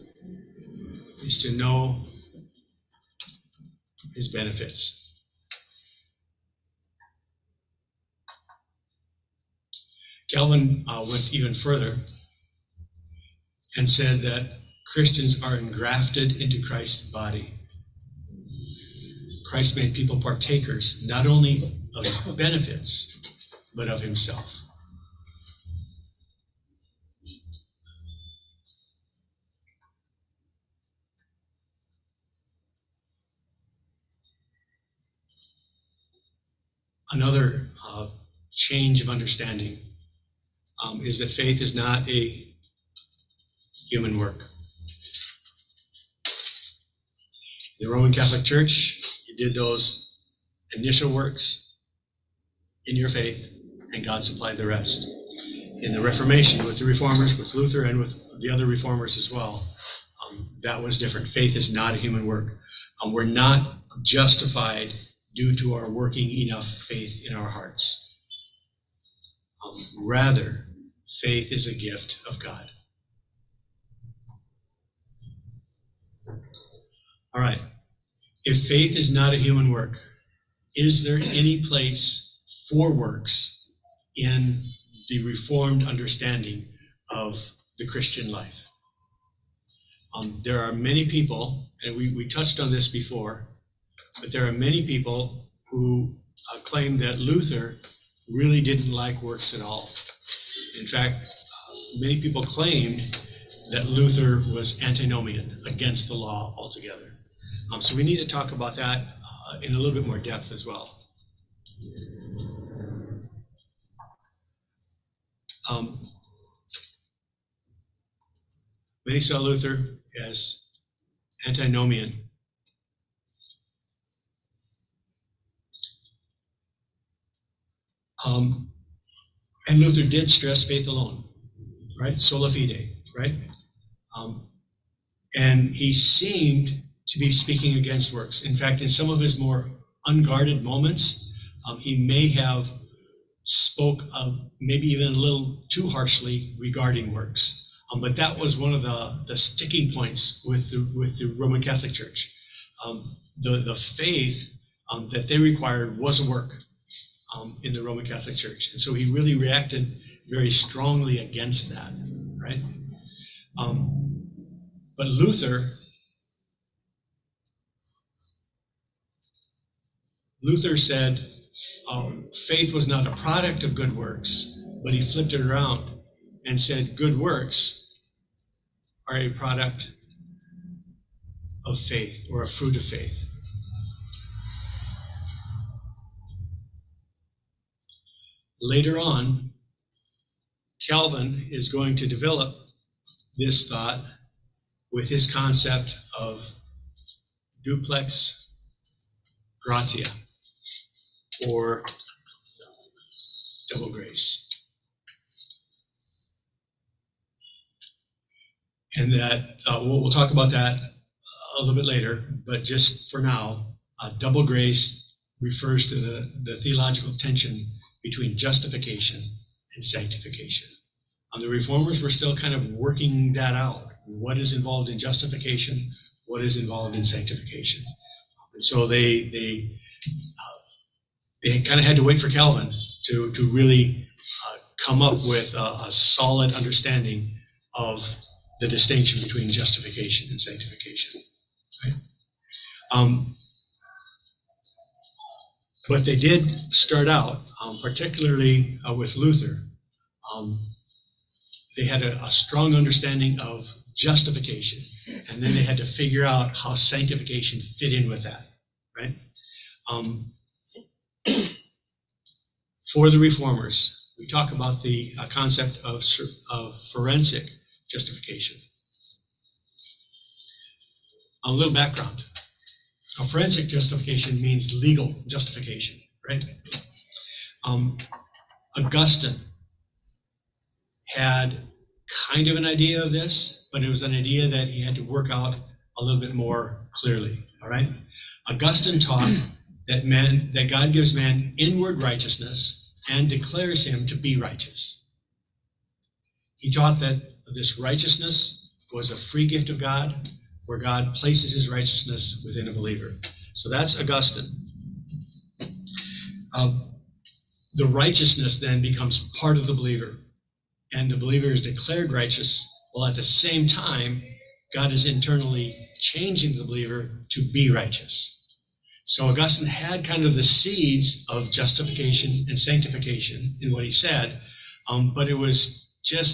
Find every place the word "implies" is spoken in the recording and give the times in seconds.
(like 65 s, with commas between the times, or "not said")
not said.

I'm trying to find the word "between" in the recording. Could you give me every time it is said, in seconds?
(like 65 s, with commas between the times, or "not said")
218 s, 239 s.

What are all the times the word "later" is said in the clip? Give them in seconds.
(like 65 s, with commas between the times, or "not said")
188 s, 211 s.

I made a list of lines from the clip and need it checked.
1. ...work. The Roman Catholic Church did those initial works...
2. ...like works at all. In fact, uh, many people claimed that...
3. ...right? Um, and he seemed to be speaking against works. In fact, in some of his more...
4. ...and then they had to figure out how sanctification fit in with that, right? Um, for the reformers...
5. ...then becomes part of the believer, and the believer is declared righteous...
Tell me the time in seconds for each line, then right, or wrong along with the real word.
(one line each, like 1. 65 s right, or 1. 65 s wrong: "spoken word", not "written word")
1. 44 s right
2. 98 s right
3. 133 s right
4. 255 s right
5. 308 s right.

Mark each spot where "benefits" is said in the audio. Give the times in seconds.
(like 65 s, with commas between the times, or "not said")
4 s, 22 s.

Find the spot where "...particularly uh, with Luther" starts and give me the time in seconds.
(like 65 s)
247 s.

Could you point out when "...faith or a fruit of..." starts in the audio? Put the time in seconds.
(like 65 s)
181 s.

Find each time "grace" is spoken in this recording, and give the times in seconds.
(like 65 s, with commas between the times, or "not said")
203 s, 214 s.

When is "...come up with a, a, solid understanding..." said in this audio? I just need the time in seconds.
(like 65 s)
234 s.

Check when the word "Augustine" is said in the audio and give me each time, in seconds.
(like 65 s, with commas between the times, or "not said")
278 s, 288 s, 303 s, 319 s.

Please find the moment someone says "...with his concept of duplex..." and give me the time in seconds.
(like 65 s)
194 s.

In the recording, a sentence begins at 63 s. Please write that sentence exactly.
Um, we're not justified due to our working enough faith in our hearts.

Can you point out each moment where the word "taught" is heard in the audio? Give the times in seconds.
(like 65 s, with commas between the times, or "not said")
289 s, 296 s.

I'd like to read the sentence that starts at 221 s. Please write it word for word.
Um, the reformers were still kind of working that out.